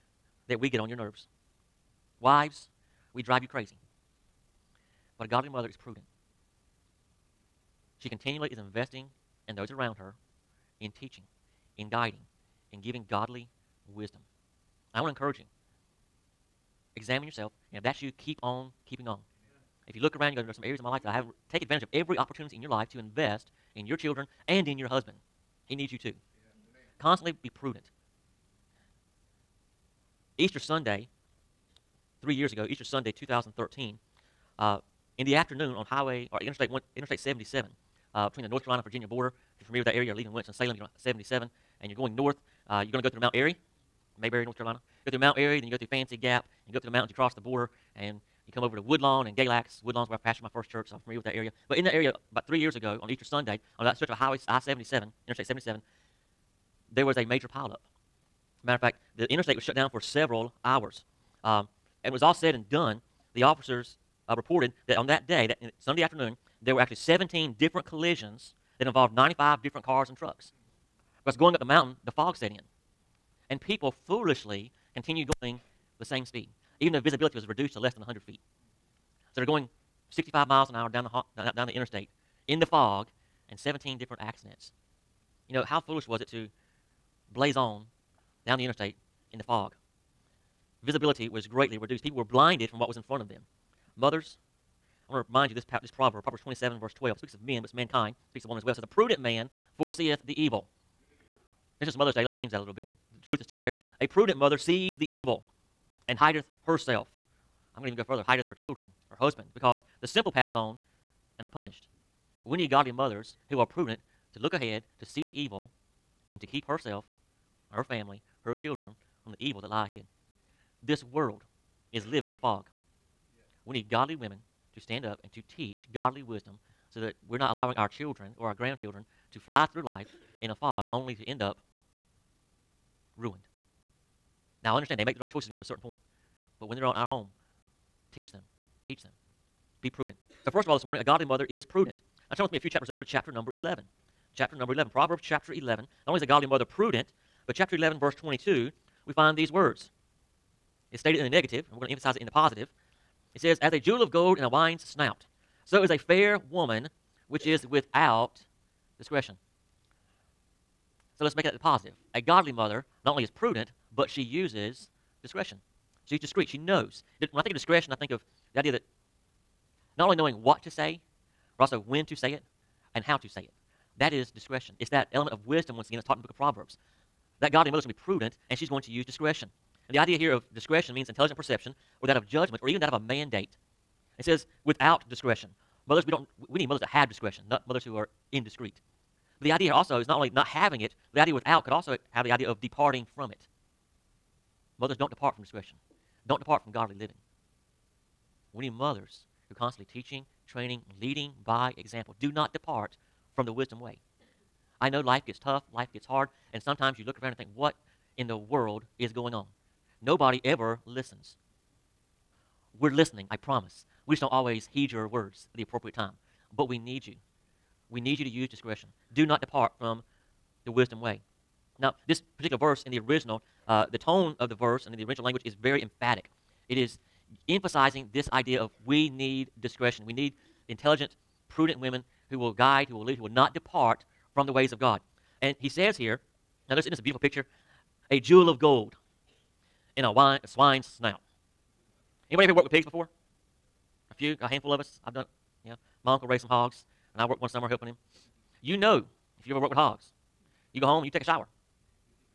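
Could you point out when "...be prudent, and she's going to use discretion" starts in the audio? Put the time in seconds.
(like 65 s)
177 s.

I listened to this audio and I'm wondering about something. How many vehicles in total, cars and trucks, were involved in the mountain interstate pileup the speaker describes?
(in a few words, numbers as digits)
95.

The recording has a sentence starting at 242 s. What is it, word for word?
Anybody ever worked with pigs before?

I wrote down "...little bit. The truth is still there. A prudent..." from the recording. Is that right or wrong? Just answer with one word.
right.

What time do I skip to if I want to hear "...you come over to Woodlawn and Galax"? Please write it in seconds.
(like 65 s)
48 s.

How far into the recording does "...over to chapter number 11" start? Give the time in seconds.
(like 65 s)
142 s.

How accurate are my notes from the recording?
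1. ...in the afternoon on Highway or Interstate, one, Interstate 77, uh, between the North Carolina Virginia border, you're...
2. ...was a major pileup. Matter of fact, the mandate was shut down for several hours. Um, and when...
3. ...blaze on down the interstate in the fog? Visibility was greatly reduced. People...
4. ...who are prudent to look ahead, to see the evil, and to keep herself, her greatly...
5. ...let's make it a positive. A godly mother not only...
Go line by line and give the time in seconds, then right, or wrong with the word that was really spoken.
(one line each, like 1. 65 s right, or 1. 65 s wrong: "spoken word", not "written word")
1. 35 s right
2. 57 s wrong: "interstate", not "mandate"
3. 87 s right
4. 113 s wrong: "family", not "greatly"
5. 161 s right.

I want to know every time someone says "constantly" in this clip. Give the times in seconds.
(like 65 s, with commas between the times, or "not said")
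26 s, 199 s.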